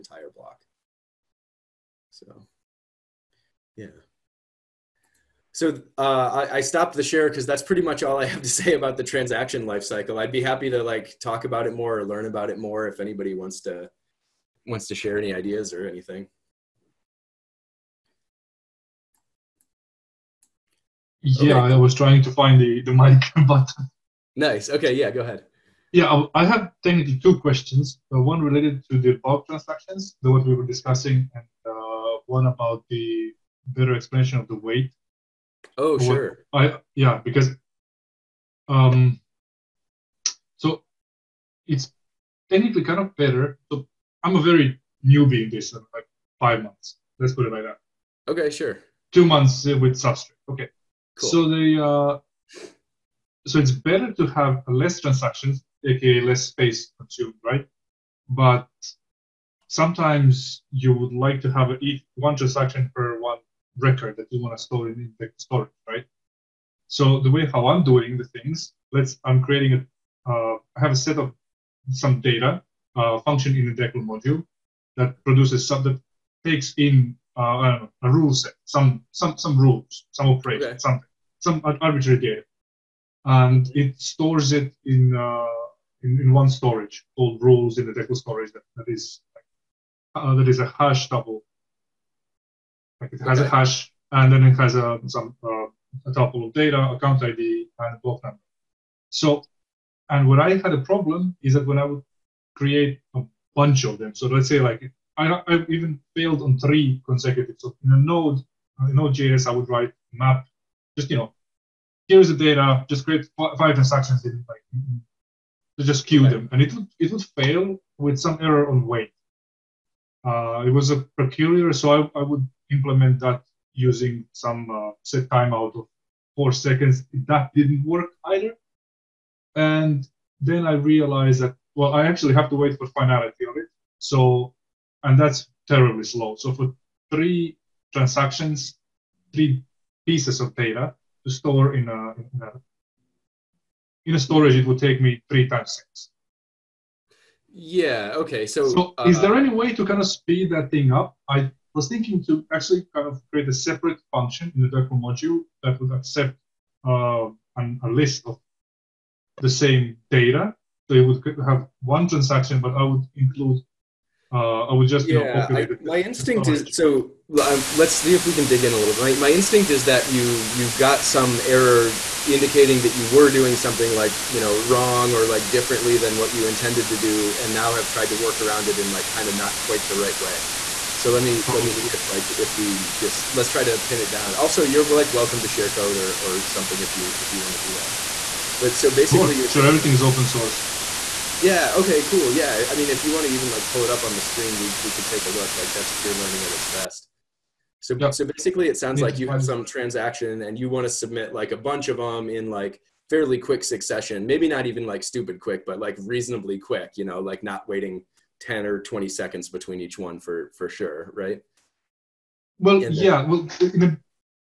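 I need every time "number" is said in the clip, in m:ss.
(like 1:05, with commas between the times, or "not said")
1:38.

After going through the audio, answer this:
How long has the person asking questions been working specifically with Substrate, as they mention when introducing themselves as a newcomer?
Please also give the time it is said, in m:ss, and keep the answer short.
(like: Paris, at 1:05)
2 months, at 0:49.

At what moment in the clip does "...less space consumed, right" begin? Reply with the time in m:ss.
0:56.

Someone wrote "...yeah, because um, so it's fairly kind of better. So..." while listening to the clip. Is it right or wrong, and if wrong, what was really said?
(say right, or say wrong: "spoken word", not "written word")
wrong: "technically", not "fairly".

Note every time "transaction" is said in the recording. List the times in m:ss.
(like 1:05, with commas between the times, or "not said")
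0:09, 0:29, 0:54, 1:02, 1:53, 2:17, 2:42, 3:19.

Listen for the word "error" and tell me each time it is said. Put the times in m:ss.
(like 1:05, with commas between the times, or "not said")
1:58, 2:51.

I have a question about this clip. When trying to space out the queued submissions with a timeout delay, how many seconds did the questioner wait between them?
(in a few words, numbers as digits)
4 seconds.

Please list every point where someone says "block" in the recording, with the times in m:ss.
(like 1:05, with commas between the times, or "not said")
0:00, 1:38.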